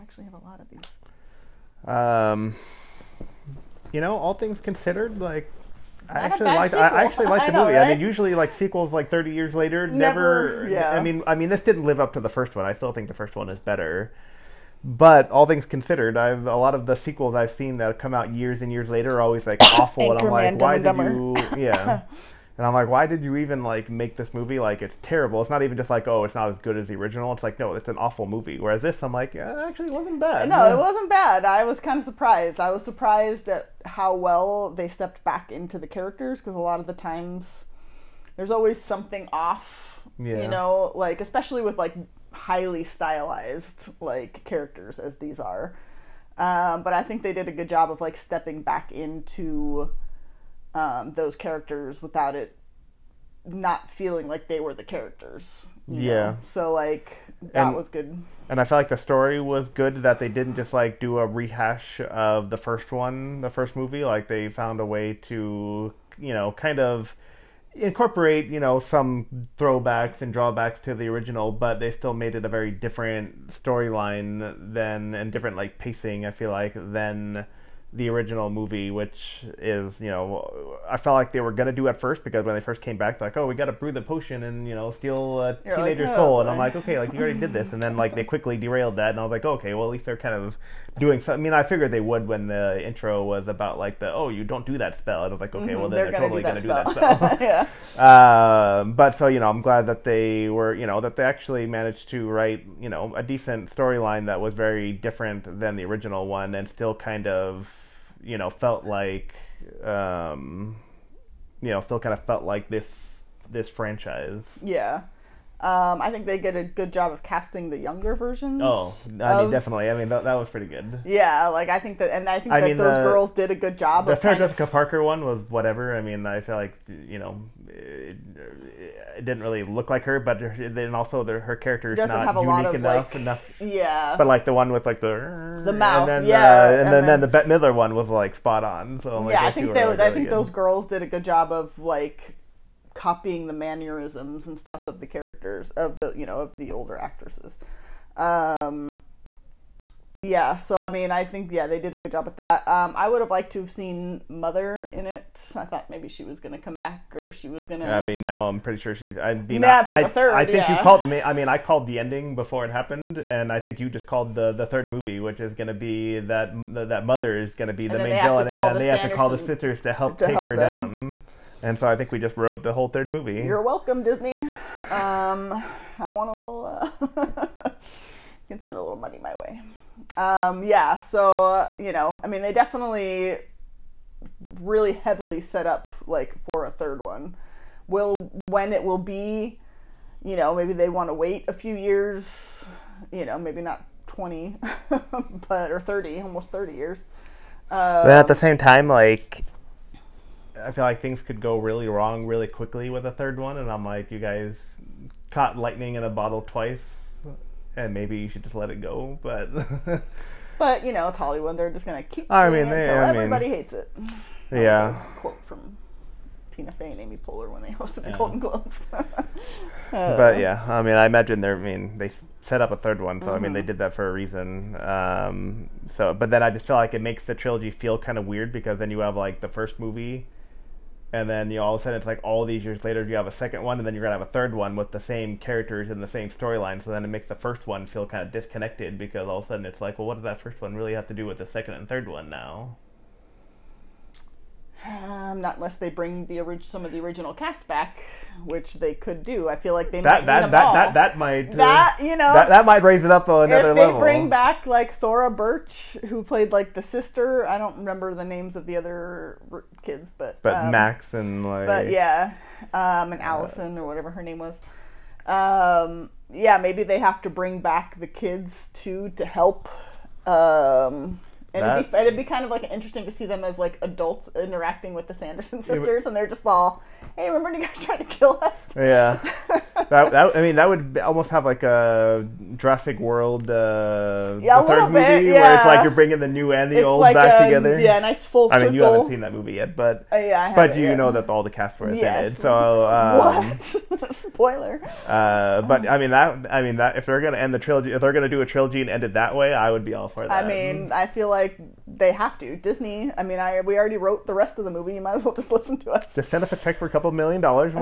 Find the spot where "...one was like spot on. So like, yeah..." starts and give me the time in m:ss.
2:17.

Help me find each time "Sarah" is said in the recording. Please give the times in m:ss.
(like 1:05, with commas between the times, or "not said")
2:04.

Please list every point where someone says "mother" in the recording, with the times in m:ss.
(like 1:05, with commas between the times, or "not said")
2:34, 2:47.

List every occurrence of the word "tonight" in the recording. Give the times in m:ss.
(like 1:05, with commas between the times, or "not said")
not said.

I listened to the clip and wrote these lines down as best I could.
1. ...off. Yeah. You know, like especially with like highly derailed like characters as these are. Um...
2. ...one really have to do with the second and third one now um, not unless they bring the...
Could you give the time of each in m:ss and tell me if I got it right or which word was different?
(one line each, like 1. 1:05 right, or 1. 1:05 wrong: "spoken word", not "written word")
1. 0:39 wrong: "stylized", not "derailed"
2. 4:00 right.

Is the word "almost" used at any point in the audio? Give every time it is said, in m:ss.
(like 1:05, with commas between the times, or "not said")
3:16, 4:40.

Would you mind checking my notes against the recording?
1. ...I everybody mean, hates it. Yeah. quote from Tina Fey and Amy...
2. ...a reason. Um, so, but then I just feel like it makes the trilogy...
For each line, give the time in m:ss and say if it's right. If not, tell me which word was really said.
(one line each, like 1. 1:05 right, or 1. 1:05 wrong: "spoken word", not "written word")
1. 3:32 right
2. 3:44 right.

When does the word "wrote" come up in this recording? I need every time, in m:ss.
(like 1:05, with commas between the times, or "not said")
2:52, 5:03.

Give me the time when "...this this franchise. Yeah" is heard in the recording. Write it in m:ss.
1:52.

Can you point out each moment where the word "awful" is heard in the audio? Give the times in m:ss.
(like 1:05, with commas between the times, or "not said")
0:19, 0:27.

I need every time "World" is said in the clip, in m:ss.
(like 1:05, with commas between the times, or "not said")
4:42.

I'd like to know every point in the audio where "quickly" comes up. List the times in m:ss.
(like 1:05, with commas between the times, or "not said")
1:28, 3:22.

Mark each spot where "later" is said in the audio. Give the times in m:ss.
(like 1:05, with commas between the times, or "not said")
0:09, 0:18, 3:52.